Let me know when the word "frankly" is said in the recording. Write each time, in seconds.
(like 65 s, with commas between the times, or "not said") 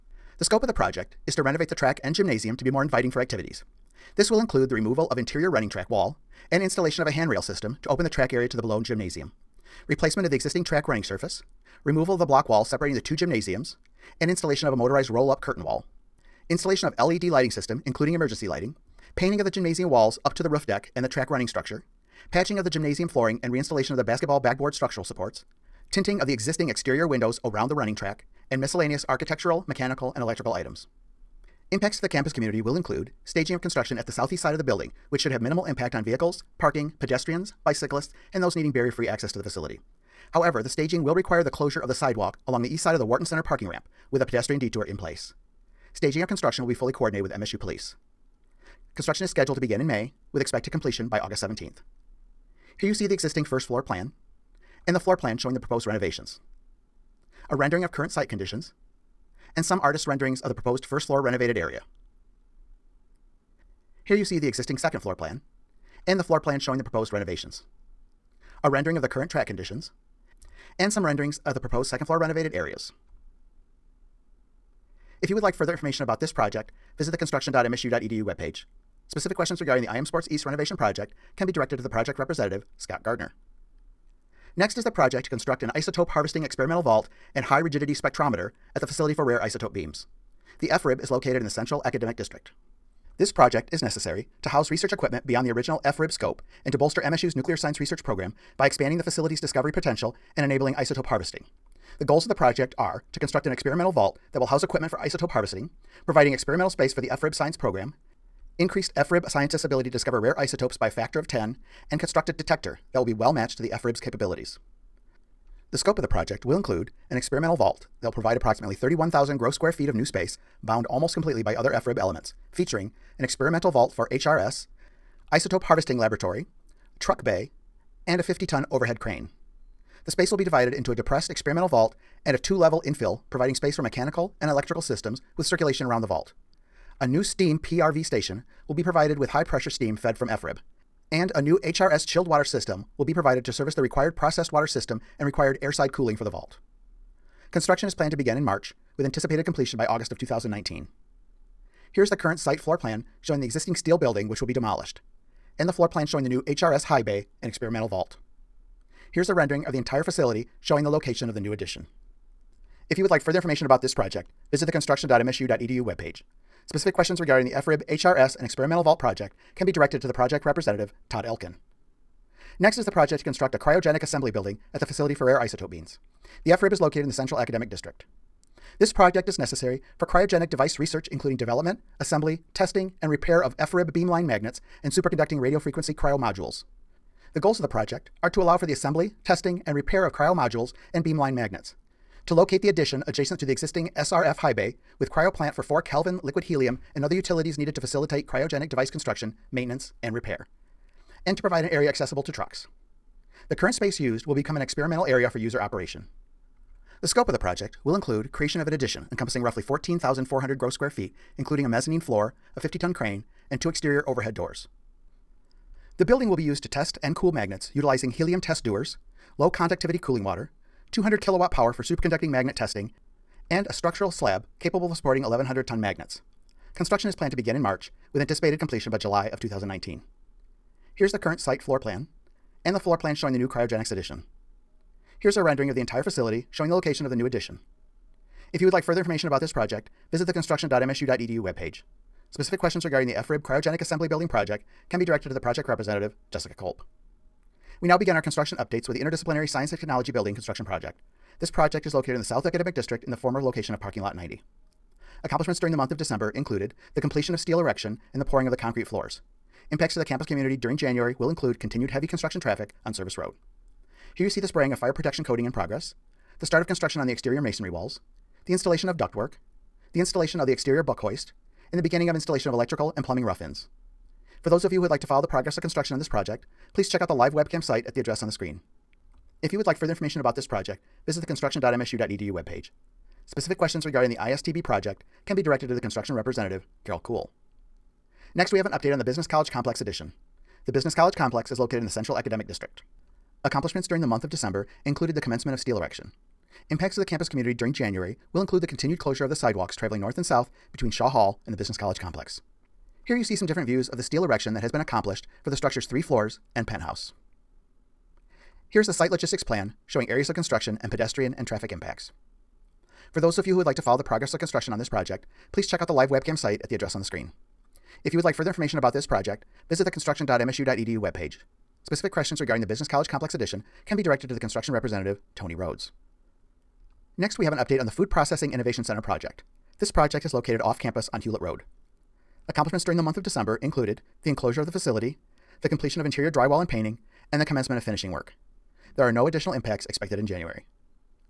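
not said.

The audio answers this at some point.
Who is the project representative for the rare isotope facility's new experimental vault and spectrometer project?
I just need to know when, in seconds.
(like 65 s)
171 s.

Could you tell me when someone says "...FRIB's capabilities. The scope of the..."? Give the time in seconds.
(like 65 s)
113 s.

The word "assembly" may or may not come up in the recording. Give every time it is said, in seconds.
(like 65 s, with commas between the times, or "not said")
174 s, 181 s, 188 s, 243 s.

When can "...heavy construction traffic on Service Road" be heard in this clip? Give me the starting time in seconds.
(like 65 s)
261 s.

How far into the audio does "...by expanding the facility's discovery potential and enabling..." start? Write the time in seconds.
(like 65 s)
98 s.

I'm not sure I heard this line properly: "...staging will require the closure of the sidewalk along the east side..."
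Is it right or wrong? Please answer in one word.
right.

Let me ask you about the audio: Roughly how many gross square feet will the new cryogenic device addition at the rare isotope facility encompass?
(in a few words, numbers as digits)
14,400.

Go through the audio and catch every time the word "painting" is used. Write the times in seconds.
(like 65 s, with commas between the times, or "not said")
19 s, 336 s.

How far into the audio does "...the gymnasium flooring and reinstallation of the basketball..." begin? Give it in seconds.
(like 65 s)
22 s.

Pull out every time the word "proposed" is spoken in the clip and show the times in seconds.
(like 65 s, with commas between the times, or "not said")
55 s, 60 s, 66 s, 71 s.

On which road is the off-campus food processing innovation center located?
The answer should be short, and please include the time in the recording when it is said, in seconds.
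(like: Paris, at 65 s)
Hulett Road, at 331 s.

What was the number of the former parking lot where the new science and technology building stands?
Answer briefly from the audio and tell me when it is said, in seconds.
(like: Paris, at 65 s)
90, at 253 s.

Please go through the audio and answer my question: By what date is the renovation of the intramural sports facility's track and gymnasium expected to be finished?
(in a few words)
August 17.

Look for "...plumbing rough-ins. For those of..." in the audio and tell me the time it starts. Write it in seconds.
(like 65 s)
273 s.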